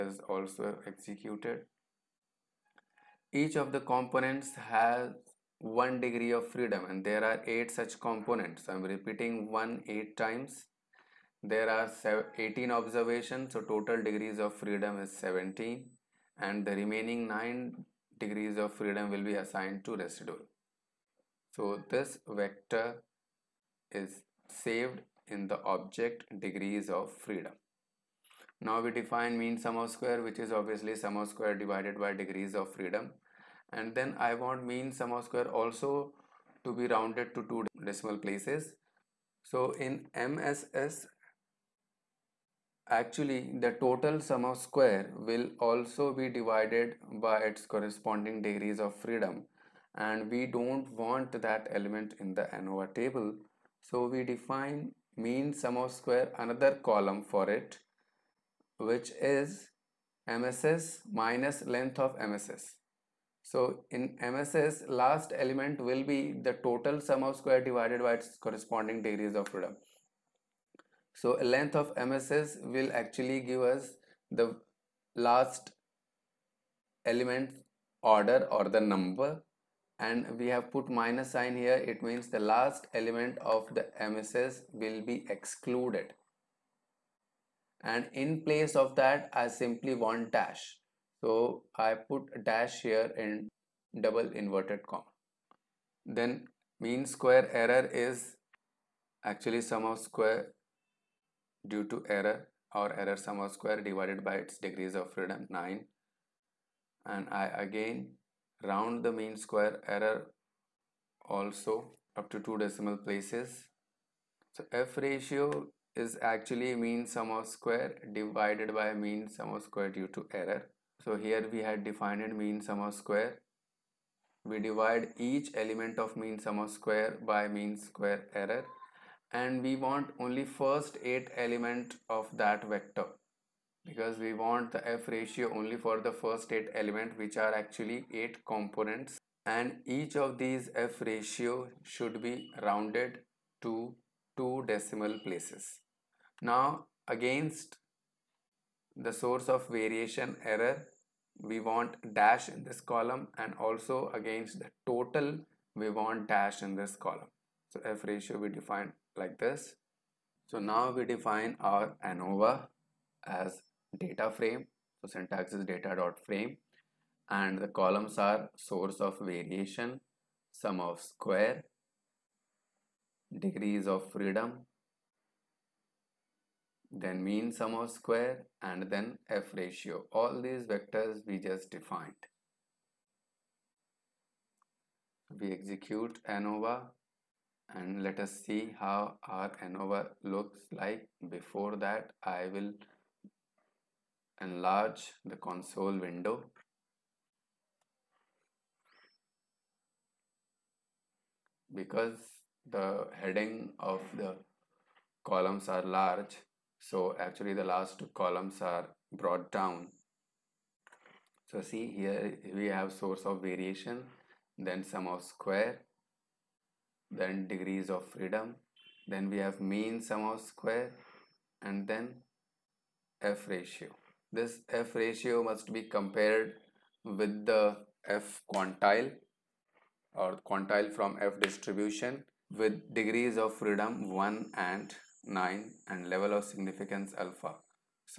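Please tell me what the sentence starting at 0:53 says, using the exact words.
So we define mean sum of square another column for it which is MSS minus length of MSS.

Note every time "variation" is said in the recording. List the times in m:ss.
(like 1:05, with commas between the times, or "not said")
2:29, 2:49, 3:33.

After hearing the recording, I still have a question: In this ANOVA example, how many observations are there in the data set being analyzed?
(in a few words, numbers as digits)
18.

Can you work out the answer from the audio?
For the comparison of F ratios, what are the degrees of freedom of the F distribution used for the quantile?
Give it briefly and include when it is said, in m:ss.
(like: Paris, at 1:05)
1 and 9, at 3:54.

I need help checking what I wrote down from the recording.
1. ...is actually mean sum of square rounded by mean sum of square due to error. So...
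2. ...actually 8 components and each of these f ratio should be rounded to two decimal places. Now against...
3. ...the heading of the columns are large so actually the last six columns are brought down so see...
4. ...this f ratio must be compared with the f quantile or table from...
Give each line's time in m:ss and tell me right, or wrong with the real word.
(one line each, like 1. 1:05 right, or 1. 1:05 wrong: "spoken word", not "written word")
1. 1:56 wrong: "divided", not "rounded"
2. 2:17 right
3. 3:22 wrong: "two", not "six"
4. 3:44 wrong: "quantile", not "table".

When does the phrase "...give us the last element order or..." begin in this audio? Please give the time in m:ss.
1:13.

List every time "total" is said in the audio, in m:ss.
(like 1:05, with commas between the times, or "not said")
0:13, 0:43, 1:06, 2:34.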